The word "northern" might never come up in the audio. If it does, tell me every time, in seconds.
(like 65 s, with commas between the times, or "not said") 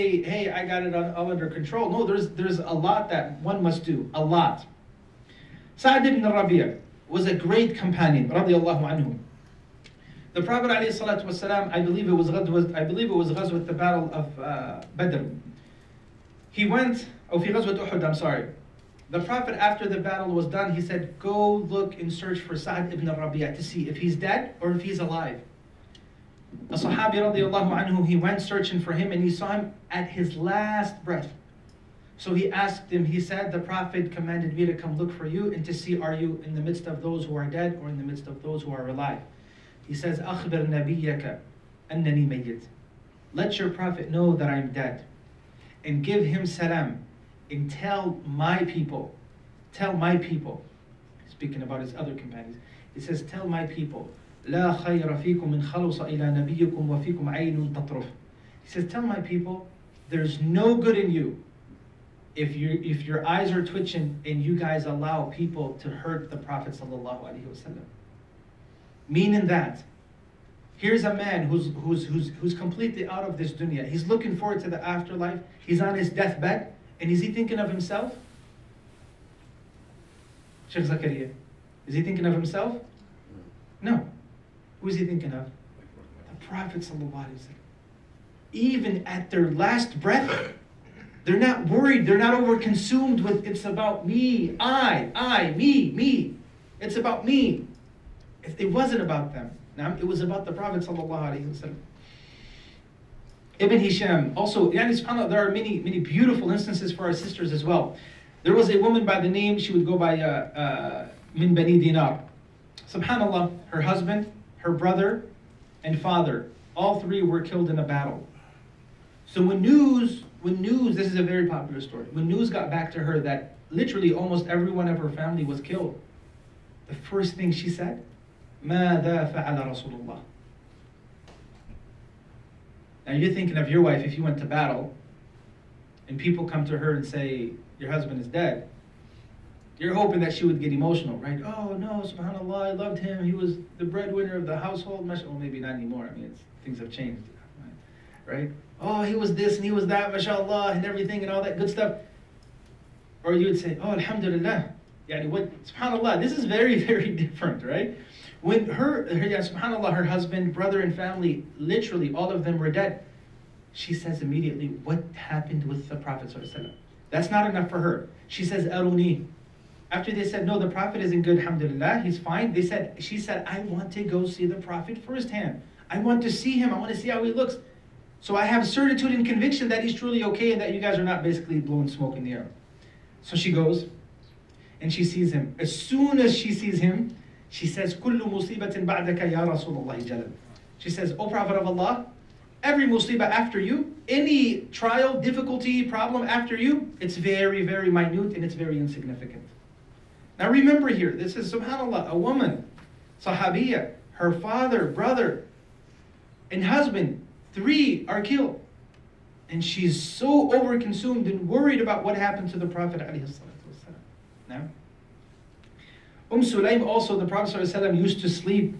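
not said.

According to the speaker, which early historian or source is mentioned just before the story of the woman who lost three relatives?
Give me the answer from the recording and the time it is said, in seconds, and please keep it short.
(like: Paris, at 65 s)
Ibn Hisham, at 103 s.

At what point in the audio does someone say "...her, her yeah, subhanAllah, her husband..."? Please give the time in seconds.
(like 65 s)
158 s.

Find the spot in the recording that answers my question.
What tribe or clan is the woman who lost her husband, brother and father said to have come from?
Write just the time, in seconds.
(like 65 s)
111 s.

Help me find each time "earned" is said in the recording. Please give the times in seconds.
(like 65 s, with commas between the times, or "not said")
not said.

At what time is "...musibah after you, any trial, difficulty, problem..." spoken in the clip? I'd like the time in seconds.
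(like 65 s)
192 s.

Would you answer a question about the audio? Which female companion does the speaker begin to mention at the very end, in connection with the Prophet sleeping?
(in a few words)
Umm Sulaim.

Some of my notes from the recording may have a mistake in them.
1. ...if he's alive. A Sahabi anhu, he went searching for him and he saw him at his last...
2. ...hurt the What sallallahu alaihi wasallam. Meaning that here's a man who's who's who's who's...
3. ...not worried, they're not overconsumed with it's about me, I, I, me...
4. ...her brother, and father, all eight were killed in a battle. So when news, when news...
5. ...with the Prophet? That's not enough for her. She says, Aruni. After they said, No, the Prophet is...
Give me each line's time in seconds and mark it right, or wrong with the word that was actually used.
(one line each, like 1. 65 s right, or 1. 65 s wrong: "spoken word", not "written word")
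1. 24 s right
2. 65 s wrong: "Prophet", not "What"
3. 91 s right
4. 114 s wrong: "three", not "eight"
5. 165 s right.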